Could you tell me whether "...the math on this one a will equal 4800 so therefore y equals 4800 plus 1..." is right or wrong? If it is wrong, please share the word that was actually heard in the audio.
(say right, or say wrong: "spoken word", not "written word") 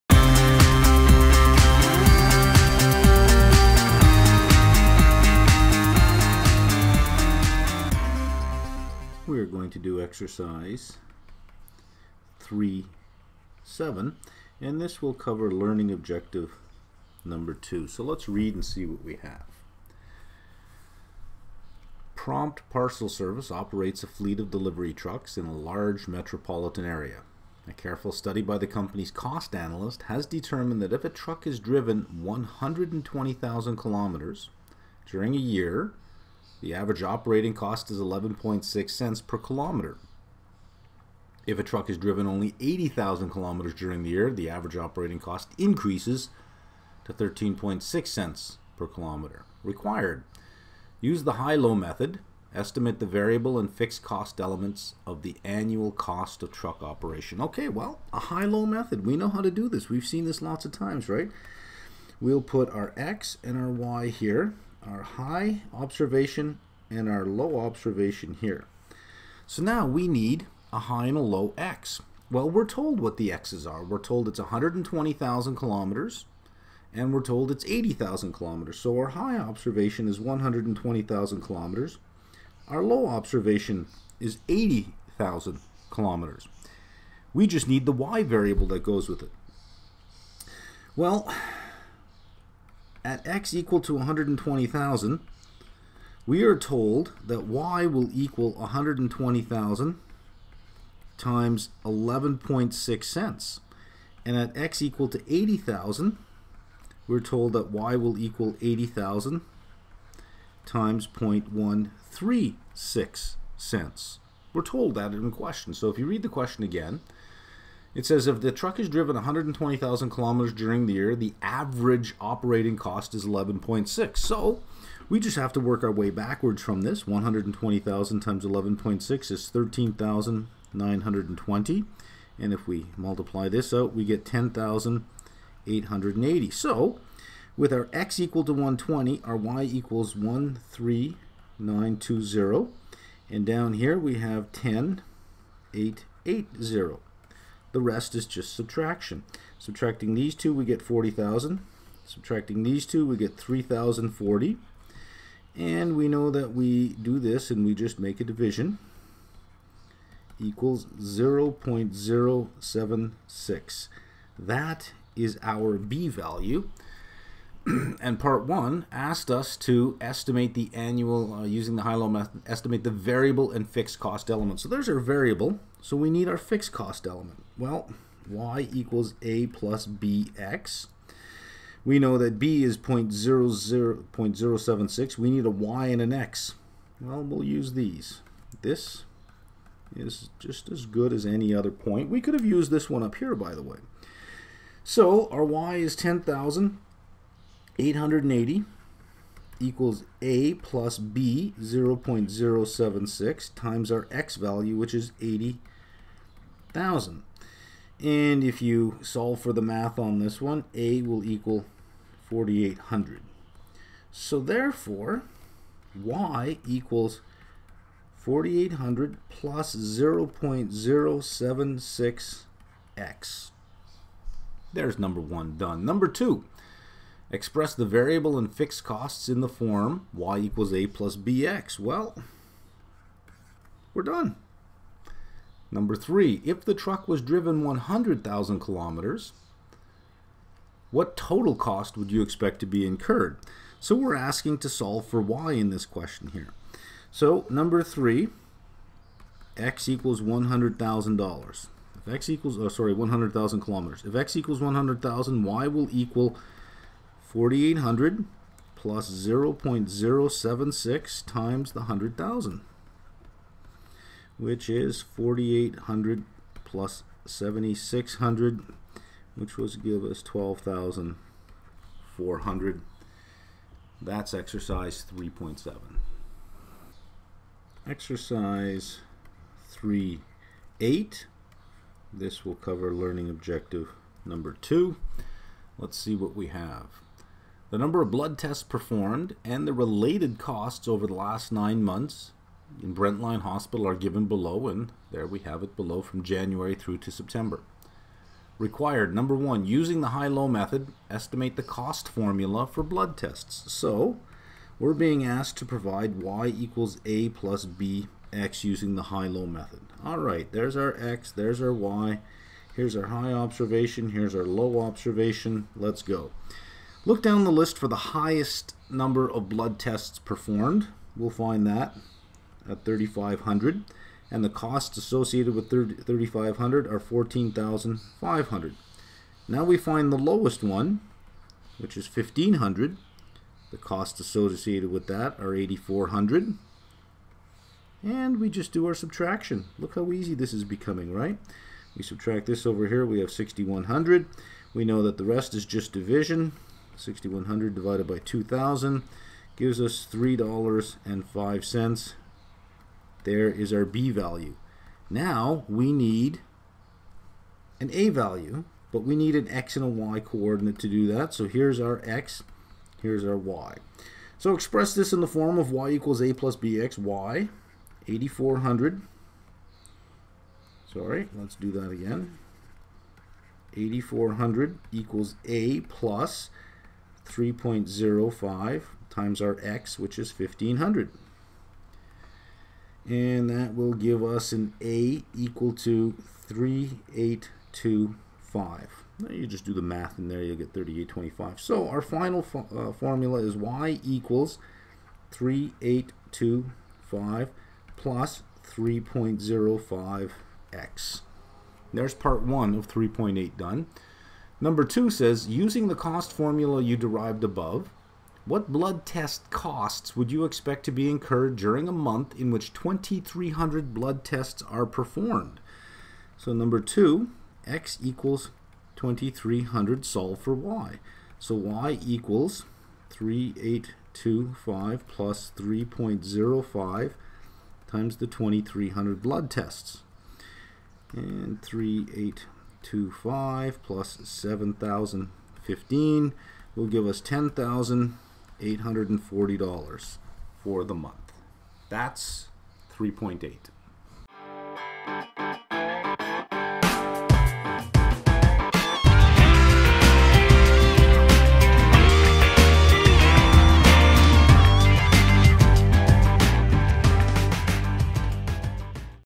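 wrong: "0", not "1".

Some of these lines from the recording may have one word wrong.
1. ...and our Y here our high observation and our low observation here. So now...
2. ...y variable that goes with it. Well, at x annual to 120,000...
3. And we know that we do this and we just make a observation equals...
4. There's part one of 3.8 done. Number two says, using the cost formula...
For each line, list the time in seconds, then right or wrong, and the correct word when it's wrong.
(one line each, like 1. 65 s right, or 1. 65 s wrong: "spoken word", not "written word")
1. 63 s right
2. 87 s wrong: "equal", not "annual"
3. 155 s wrong: "division", not "observation"
4. 401 s right.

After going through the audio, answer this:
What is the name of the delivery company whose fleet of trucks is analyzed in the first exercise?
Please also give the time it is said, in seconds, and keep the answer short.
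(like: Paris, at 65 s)
Prompt Parcel Service, at 22 s.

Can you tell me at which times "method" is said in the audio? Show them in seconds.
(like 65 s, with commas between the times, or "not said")
51 s, 58 s, 172 s, 300 s, 309 s.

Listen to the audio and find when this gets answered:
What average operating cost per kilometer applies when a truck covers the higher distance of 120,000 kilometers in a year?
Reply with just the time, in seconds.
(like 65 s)
37 s.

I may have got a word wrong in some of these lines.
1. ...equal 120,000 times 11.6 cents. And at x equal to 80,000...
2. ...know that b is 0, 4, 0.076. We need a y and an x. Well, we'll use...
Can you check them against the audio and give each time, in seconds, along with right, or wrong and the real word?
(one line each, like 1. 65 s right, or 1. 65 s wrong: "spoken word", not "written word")
1. 98 s right
2. 181 s wrong: "0", not "4".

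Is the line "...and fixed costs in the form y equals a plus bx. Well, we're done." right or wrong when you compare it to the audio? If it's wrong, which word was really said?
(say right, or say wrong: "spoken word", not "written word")
right.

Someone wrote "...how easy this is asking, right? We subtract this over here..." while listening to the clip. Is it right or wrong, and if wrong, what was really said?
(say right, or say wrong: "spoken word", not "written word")
wrong: "becoming", not "asking".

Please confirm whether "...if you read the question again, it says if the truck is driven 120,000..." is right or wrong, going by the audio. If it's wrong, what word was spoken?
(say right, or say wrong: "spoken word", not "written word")
right.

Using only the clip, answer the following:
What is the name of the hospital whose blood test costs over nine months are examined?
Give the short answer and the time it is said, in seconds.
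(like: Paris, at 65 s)
Brentline Hospital, at 292 s.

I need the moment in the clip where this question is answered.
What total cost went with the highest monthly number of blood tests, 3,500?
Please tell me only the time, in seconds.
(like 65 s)
326 s.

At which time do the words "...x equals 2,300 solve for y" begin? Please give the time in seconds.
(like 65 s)
417 s.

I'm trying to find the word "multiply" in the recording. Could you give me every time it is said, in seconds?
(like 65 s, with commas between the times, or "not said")
132 s.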